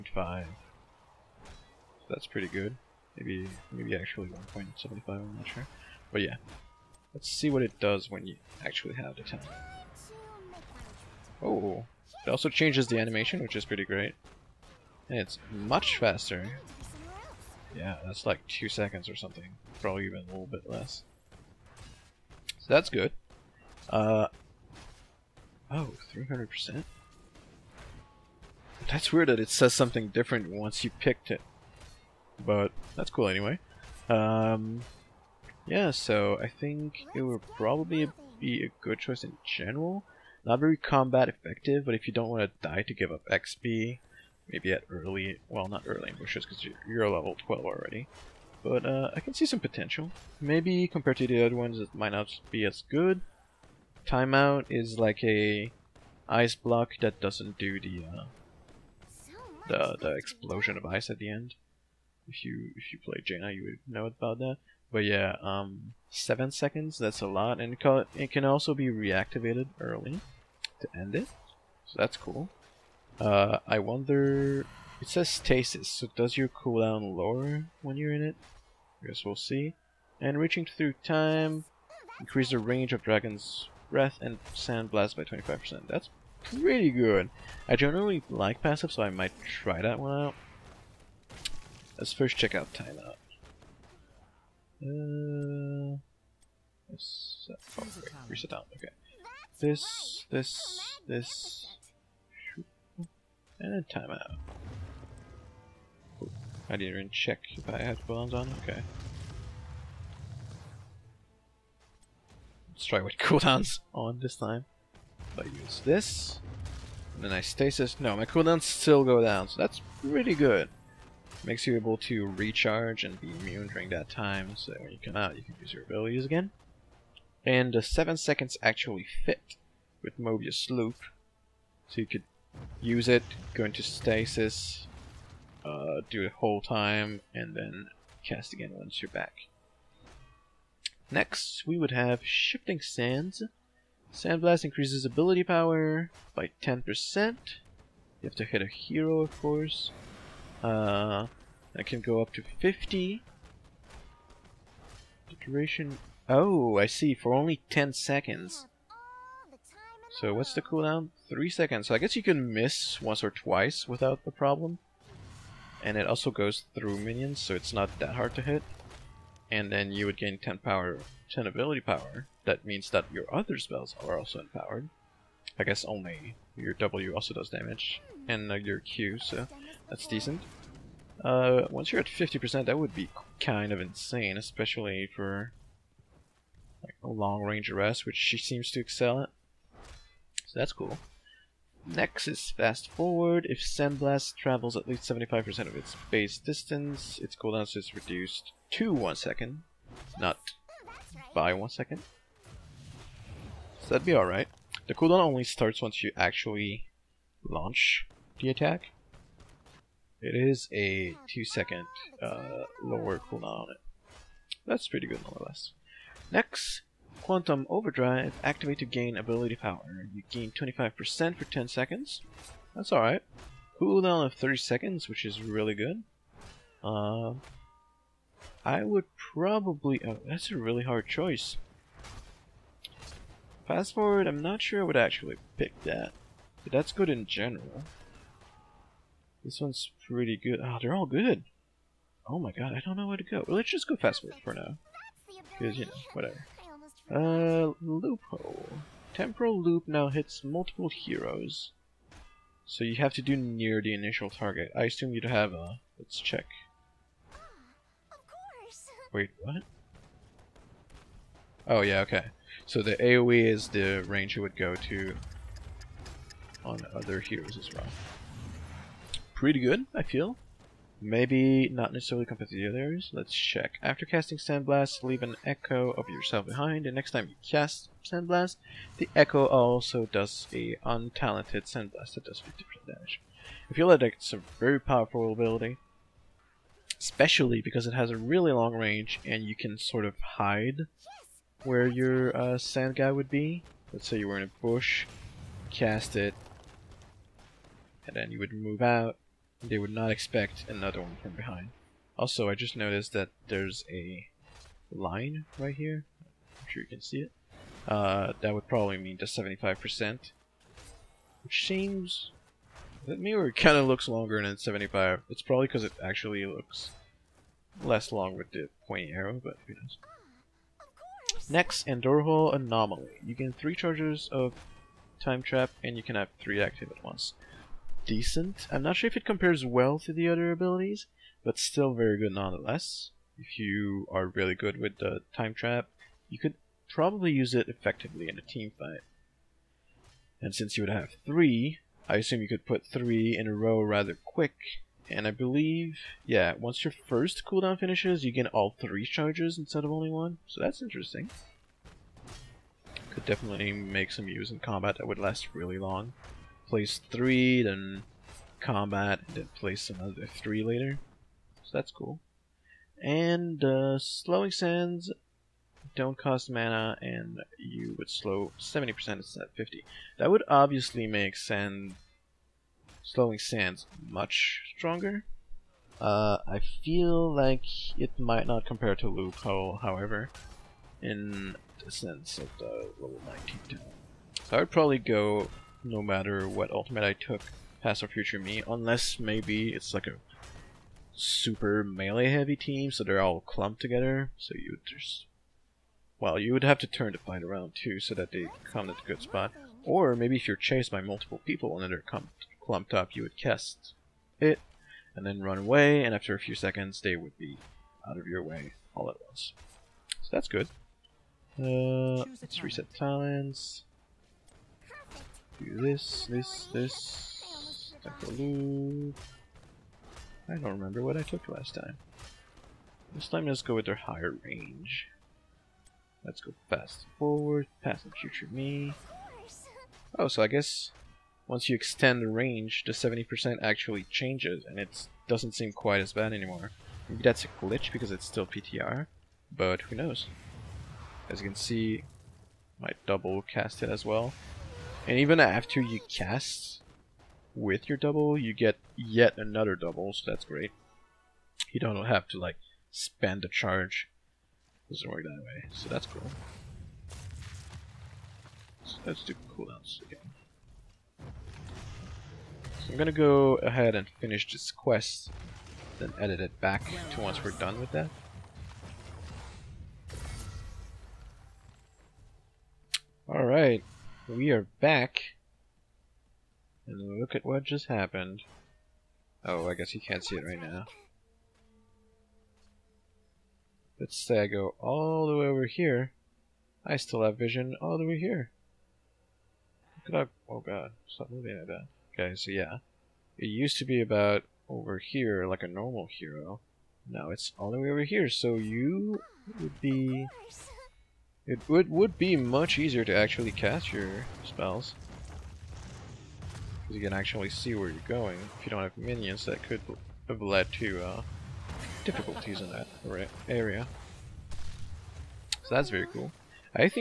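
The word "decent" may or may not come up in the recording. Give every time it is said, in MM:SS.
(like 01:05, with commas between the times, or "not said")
03:00, 05:28.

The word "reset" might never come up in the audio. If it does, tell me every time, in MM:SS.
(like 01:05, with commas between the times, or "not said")
01:38, 06:52.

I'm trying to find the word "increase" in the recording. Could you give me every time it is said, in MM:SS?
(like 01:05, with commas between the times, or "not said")
01:22, 02:24.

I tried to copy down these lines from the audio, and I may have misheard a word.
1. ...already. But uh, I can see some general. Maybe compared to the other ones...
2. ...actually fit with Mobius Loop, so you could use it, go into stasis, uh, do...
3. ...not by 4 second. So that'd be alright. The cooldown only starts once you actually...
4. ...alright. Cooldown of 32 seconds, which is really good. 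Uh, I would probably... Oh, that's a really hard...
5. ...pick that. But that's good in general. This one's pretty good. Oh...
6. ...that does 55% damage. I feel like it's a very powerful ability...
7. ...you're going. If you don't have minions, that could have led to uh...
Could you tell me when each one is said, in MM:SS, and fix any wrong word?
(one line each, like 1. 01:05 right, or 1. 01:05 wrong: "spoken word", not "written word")
1. 00:47 wrong: "potential", not "general"
2. 02:08 right
3. 03:20 wrong: "1", not "4"
4. 03:42 wrong: "30", not "32"
5. 03:55 right
6. 04:42 wrong: "50", not "55"
7. 08:27 right.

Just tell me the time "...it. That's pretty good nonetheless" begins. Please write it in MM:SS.
03:33.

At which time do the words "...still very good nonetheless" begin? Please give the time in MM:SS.
05:31.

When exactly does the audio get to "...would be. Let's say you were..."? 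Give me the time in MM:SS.
04:53.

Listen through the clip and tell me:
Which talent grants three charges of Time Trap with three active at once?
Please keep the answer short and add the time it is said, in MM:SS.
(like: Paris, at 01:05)
Andorhal Anomaly, at 05:21.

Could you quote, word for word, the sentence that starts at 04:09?
Temporal loop now hits multiple heroes.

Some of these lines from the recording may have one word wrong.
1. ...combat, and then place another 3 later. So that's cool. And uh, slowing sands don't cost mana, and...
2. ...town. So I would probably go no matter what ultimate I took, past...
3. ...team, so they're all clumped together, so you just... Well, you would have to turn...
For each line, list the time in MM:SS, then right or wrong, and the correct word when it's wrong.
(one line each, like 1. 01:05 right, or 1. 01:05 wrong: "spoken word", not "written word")
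1. 05:58 right
2. 06:23 right
3. 06:32 right.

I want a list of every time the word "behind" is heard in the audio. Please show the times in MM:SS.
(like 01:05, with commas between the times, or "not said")
04:36, 05:01.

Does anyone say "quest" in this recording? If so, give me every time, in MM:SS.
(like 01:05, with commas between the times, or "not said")
07:44.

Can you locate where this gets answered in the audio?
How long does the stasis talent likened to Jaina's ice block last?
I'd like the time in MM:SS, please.
01:06.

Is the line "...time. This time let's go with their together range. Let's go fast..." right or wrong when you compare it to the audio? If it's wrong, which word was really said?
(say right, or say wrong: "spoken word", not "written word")
wrong: "higher", not "together".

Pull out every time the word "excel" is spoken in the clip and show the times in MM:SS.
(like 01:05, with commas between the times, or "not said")
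03:08.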